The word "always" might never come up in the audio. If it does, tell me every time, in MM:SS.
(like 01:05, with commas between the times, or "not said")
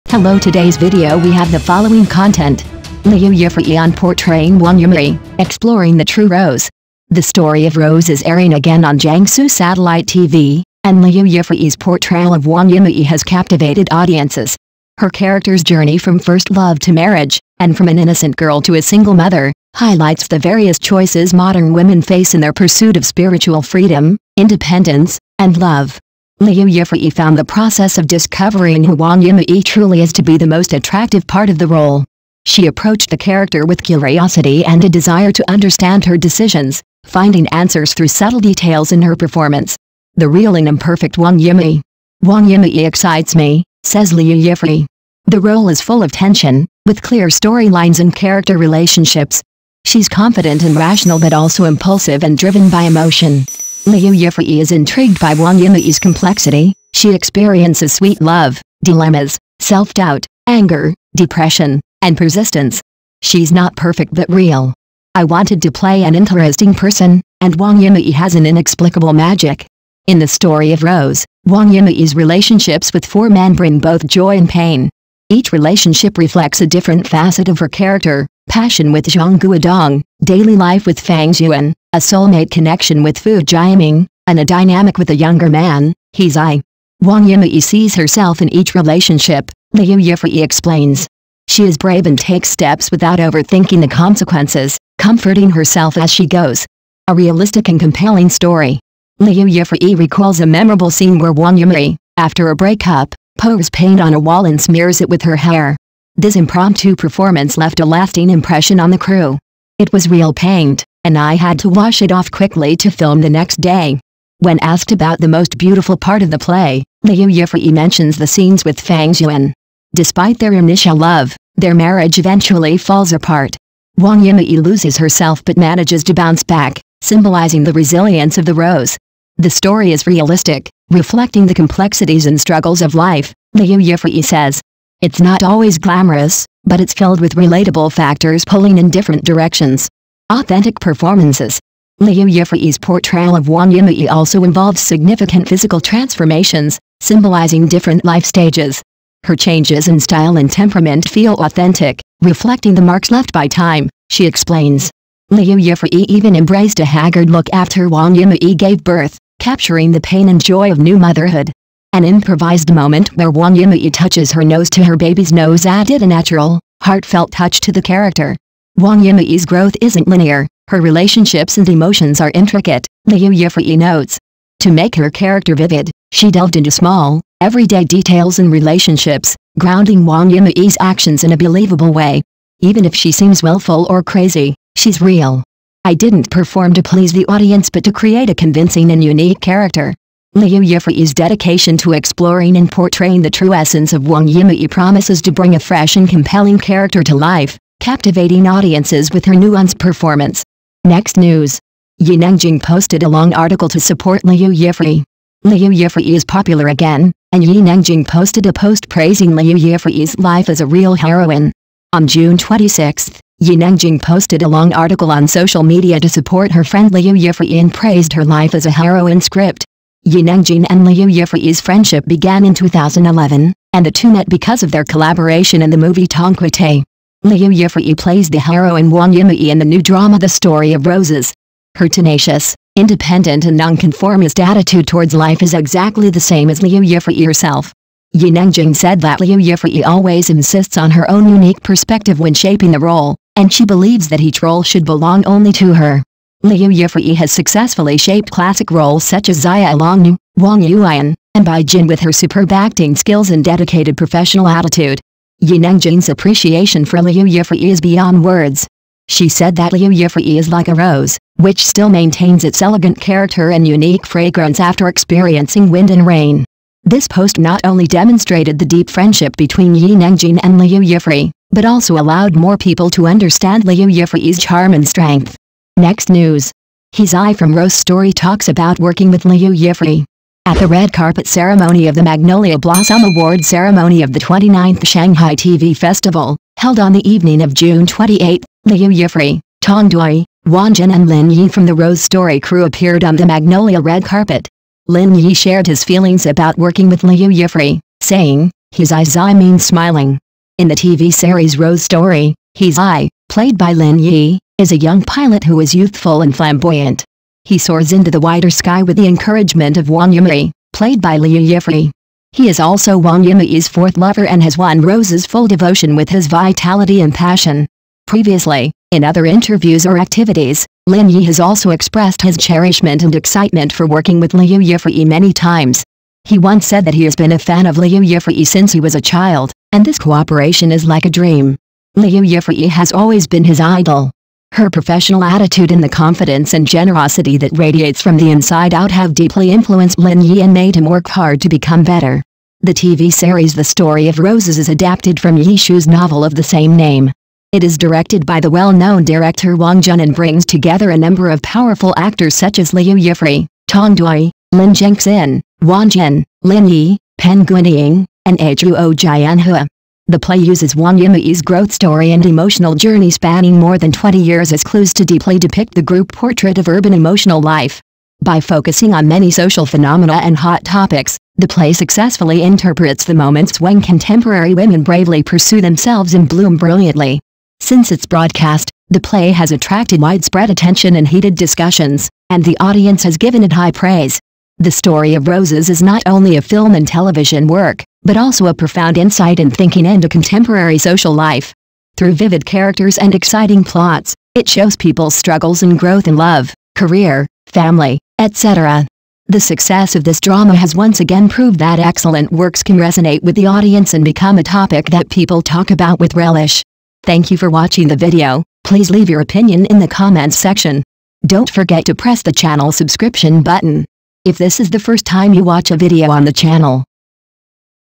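02:15, 03:59, 05:32.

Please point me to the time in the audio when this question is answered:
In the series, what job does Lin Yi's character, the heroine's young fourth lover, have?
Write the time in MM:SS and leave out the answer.
05:05.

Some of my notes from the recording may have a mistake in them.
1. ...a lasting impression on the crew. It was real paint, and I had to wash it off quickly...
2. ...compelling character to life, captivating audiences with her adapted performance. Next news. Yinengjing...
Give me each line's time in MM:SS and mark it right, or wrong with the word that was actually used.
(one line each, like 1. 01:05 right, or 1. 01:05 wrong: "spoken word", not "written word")
1. 01:47 right
2. 03:16 wrong: "nuanced", not "adapted".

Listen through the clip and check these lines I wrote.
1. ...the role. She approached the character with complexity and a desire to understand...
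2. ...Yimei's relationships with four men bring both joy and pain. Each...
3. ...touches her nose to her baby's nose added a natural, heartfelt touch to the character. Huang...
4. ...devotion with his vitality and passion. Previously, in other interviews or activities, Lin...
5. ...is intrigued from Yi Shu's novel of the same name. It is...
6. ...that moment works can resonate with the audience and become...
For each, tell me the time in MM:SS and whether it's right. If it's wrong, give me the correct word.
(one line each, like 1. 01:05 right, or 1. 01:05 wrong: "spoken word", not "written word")
1. 00:31 wrong: "curiosity", not "complexity"
2. 01:11 right
3. 02:43 right
4. 05:15 right
5. 05:44 wrong: "adapted", not "intrigued"
6. 06:41 wrong: "excellent", not "moment".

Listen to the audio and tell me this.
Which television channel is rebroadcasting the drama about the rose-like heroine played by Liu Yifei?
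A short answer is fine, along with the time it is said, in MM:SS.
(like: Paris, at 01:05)
Jiangsu Satellite TV, at 00:08.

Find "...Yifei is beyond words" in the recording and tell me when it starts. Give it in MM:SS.
04:17.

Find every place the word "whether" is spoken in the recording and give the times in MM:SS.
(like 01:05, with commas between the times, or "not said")
not said.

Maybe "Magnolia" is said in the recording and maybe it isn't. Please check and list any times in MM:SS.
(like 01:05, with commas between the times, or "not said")
04:42, 04:53.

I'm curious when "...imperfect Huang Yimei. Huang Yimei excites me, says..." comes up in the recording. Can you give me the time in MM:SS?
00:40.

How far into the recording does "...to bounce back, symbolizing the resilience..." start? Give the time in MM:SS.
02:06.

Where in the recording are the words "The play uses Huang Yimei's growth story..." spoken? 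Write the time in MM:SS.
06:00.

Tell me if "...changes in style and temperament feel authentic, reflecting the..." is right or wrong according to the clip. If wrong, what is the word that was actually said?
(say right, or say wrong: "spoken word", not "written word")
right.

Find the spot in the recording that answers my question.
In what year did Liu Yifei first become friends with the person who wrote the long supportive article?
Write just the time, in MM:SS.
03:42.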